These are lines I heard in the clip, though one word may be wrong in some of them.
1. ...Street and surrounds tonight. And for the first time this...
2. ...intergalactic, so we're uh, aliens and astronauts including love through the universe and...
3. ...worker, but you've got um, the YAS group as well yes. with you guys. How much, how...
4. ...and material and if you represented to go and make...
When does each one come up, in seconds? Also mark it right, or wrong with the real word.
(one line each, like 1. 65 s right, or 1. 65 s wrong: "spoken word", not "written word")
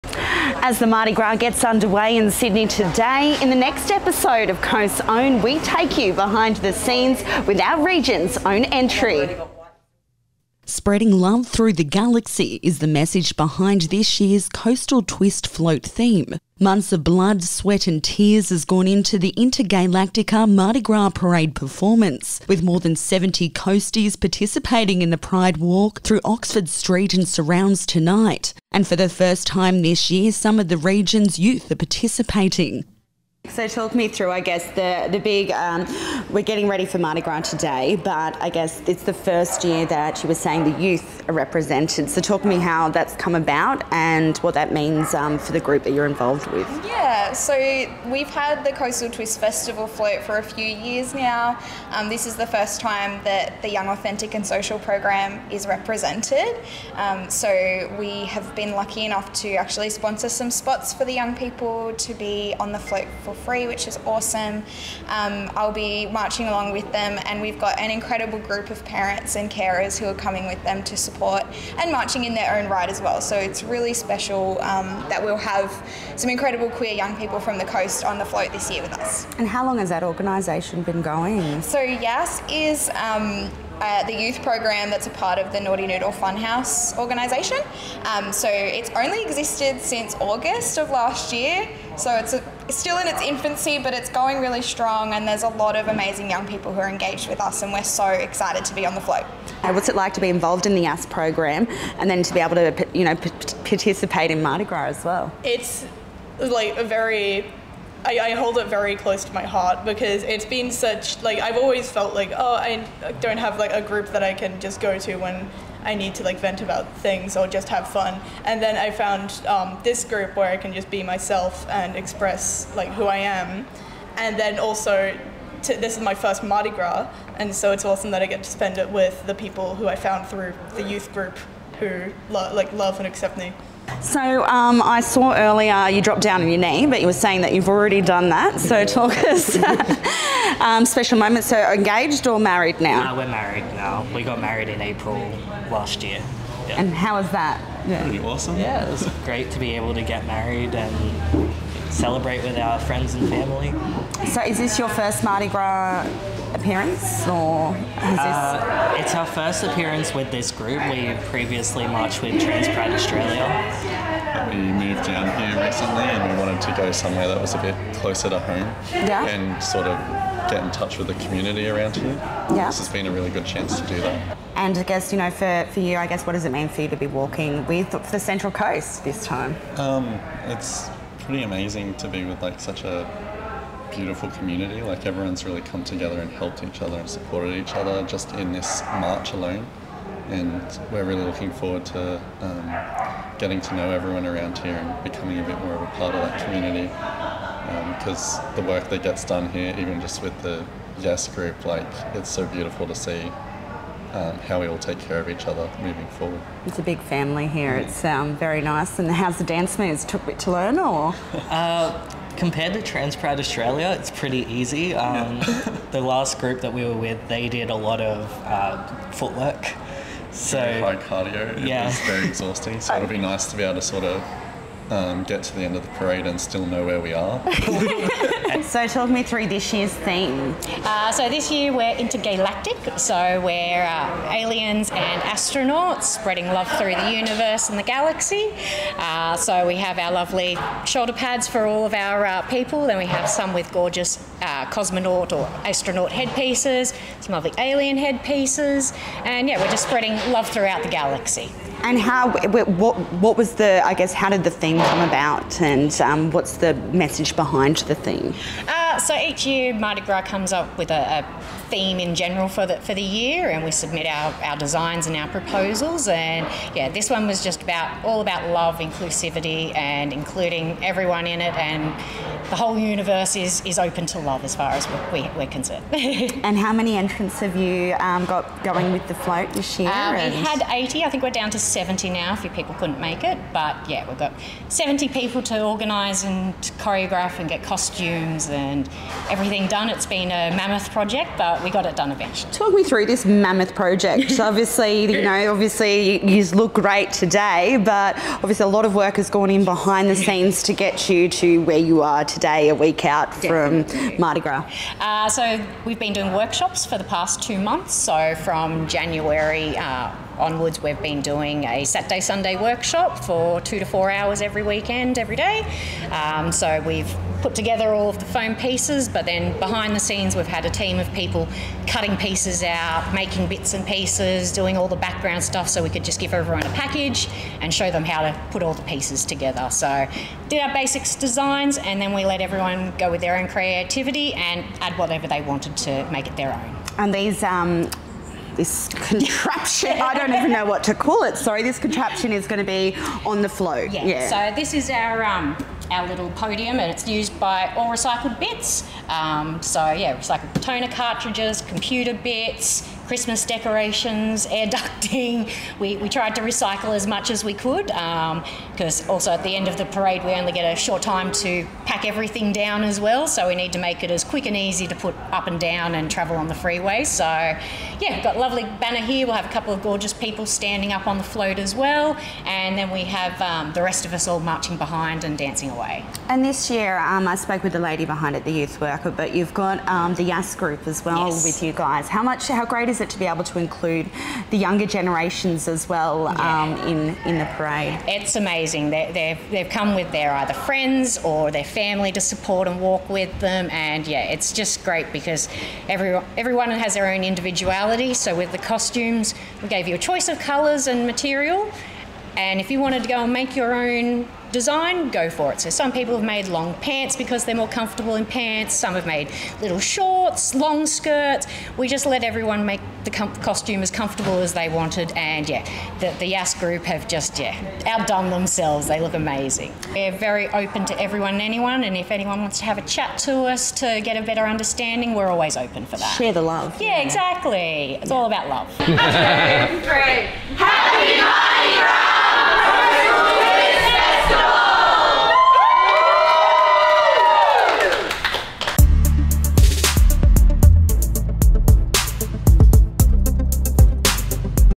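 1. 26 s right
2. 231 s wrong: "spreading", not "including"
3. 378 s right
4. 400 s wrong: "wanted", not "represented".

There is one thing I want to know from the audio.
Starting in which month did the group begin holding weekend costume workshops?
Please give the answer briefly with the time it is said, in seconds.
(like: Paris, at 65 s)
January, at 308 s.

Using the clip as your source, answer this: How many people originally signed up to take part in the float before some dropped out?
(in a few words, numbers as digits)
80.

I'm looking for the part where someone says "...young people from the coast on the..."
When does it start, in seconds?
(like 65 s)
76 s.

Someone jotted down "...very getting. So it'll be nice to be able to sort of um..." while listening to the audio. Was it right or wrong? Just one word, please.
wrong.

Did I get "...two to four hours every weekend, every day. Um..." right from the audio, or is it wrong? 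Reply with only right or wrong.
right.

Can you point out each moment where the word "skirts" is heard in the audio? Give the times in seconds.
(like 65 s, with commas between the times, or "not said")
410 s.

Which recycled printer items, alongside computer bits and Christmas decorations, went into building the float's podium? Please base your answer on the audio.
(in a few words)
toner cartridges.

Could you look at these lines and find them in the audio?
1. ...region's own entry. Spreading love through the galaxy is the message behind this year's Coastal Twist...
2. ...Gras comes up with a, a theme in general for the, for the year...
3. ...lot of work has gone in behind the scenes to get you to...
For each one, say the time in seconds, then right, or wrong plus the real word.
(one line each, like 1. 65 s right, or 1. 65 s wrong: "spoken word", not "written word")
1. 7 s right
2. 260 s right
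3. 298 s right.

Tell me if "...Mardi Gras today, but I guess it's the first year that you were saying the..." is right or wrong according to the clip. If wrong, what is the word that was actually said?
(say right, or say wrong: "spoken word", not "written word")
right.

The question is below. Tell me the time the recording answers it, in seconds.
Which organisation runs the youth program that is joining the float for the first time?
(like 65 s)
85 s.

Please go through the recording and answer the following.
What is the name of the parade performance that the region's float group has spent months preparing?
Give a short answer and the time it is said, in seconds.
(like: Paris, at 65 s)
InterGAYlatica, at 19 s.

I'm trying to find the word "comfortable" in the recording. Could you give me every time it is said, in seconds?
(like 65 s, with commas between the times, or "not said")
407 s, 413 s.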